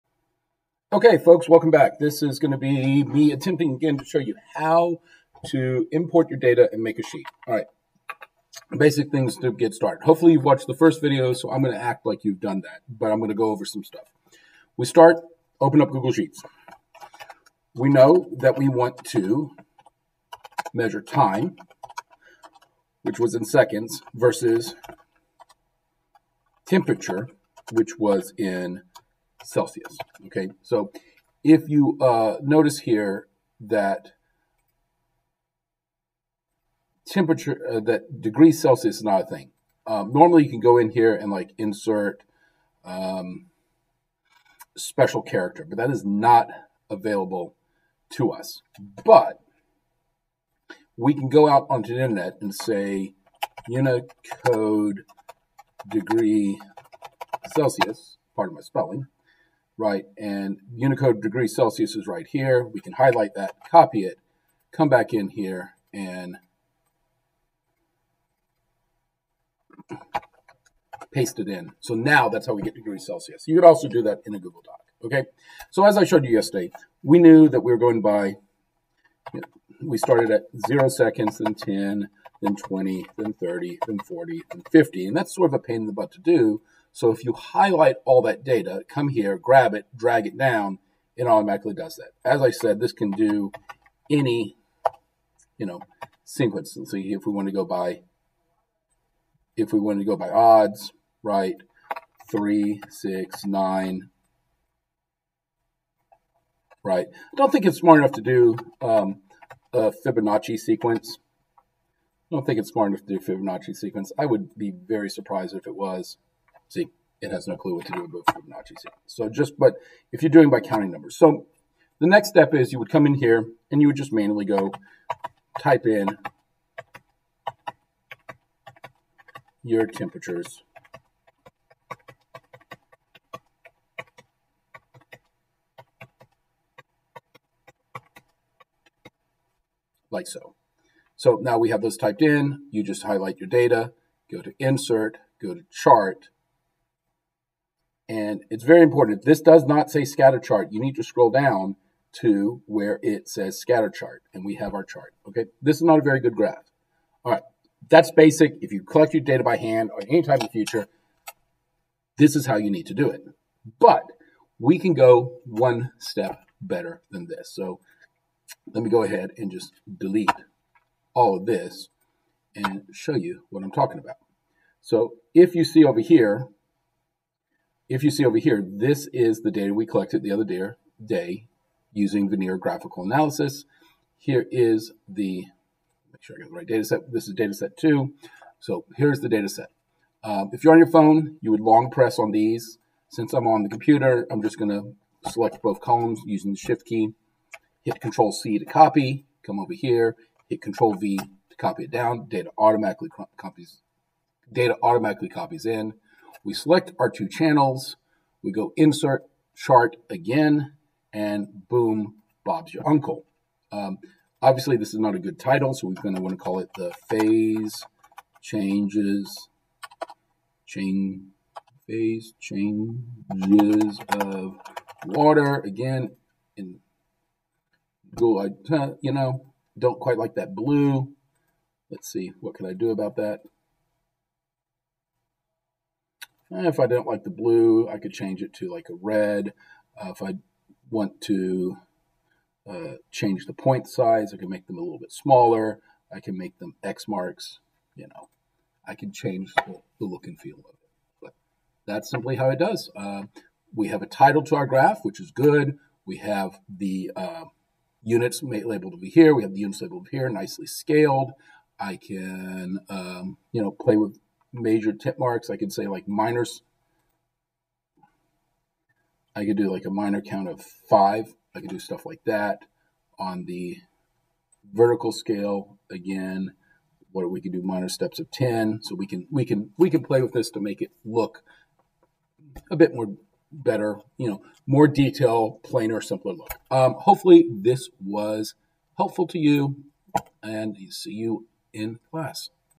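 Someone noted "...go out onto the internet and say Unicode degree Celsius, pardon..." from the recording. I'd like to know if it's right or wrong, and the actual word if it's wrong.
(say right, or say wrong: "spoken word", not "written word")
right.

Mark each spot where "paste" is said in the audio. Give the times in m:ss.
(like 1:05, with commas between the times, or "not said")
1:11.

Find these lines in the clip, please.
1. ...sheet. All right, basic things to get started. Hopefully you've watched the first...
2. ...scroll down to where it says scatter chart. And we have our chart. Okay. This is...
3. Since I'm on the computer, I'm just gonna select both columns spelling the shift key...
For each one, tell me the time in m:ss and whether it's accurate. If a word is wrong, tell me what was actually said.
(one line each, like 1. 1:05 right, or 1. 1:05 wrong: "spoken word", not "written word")
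1. 0:07 right
2. 2:31 right
3. 3:13 wrong: "using", not "spelling".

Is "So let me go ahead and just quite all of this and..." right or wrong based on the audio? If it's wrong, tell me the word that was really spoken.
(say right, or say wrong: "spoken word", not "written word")
wrong: "delete", not "quite".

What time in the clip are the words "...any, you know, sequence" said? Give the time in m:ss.
1:34.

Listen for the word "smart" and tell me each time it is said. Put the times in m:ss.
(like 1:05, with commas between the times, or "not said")
1:47, 1:52.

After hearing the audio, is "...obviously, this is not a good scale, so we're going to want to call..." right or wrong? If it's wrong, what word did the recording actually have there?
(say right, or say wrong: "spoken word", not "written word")
wrong: "title", not "scale".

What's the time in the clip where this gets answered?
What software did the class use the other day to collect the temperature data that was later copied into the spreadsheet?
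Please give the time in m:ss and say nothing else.
3:02.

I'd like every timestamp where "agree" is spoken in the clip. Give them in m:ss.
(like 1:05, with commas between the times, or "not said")
not said.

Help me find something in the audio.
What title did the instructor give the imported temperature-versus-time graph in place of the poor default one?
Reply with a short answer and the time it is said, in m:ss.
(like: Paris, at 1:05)
Phase changes of water, at 3:41.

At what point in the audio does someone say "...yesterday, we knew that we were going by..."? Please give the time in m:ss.
1:16.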